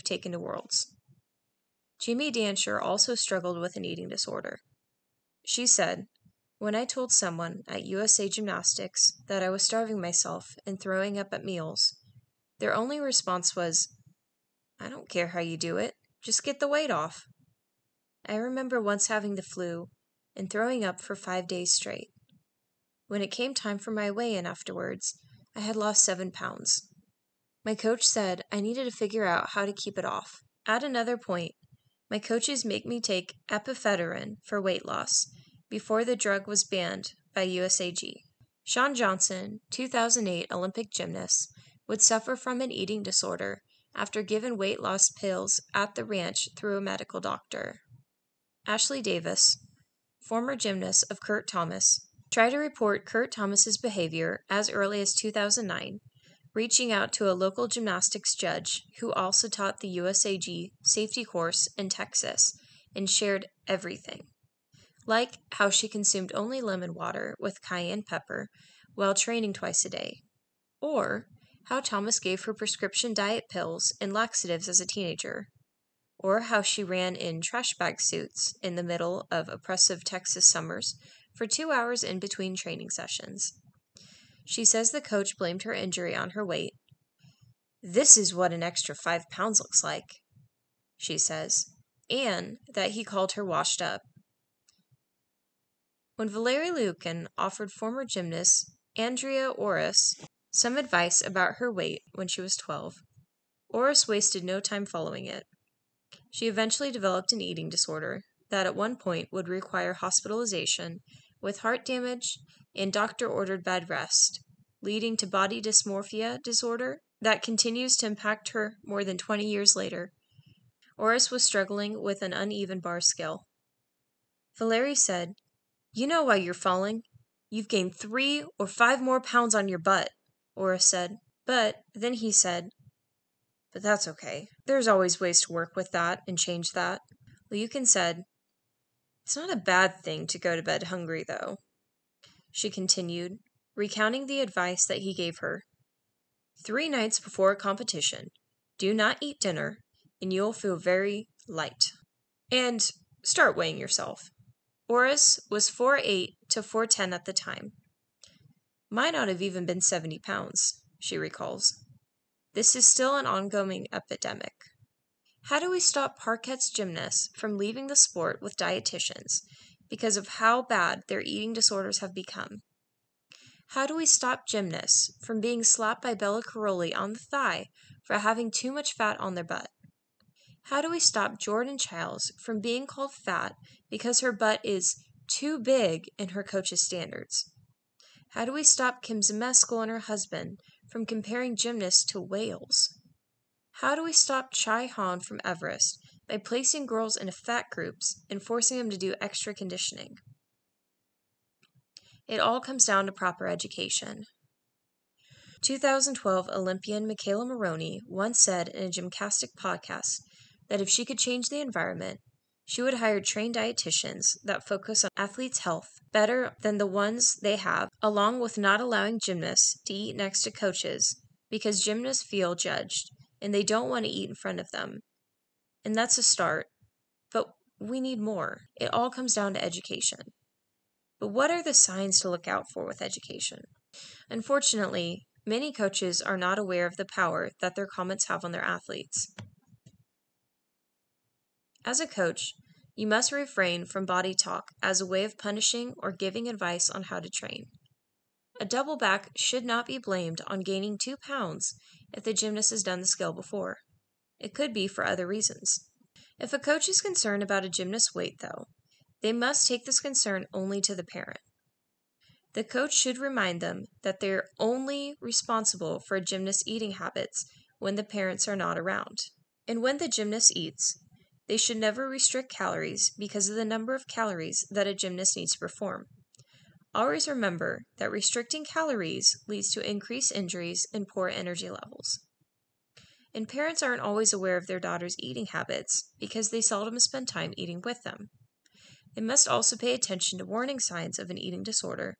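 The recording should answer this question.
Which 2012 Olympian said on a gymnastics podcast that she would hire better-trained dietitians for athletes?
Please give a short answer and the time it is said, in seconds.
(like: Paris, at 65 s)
McKayla Maroney, at 207 s.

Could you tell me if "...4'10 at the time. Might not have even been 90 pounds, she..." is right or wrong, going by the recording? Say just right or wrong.
wrong.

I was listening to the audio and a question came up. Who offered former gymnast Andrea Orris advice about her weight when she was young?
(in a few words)
Valerie Liukin.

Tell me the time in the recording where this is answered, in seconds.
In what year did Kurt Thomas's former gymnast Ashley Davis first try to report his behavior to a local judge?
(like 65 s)
55 s.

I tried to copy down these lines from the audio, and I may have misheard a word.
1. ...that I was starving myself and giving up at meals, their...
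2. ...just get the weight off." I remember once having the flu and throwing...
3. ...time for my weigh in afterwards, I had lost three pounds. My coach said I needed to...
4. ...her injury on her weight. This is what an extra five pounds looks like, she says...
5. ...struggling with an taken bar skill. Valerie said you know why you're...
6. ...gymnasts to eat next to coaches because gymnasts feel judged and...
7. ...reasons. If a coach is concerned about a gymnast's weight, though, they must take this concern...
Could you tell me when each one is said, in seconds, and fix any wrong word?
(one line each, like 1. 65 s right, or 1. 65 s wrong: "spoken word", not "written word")
1. 9 s wrong: "throwing", not "giving"
2. 16 s right
3. 23 s wrong: "seven", not "three"
4. 85 s right
5. 121 s wrong: "uneven", not "taken"
6. 219 s right
7. 255 s right.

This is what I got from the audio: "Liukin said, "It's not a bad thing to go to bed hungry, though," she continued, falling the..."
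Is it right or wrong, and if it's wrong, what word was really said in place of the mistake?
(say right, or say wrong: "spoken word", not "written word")
wrong: "recounting", not "falling".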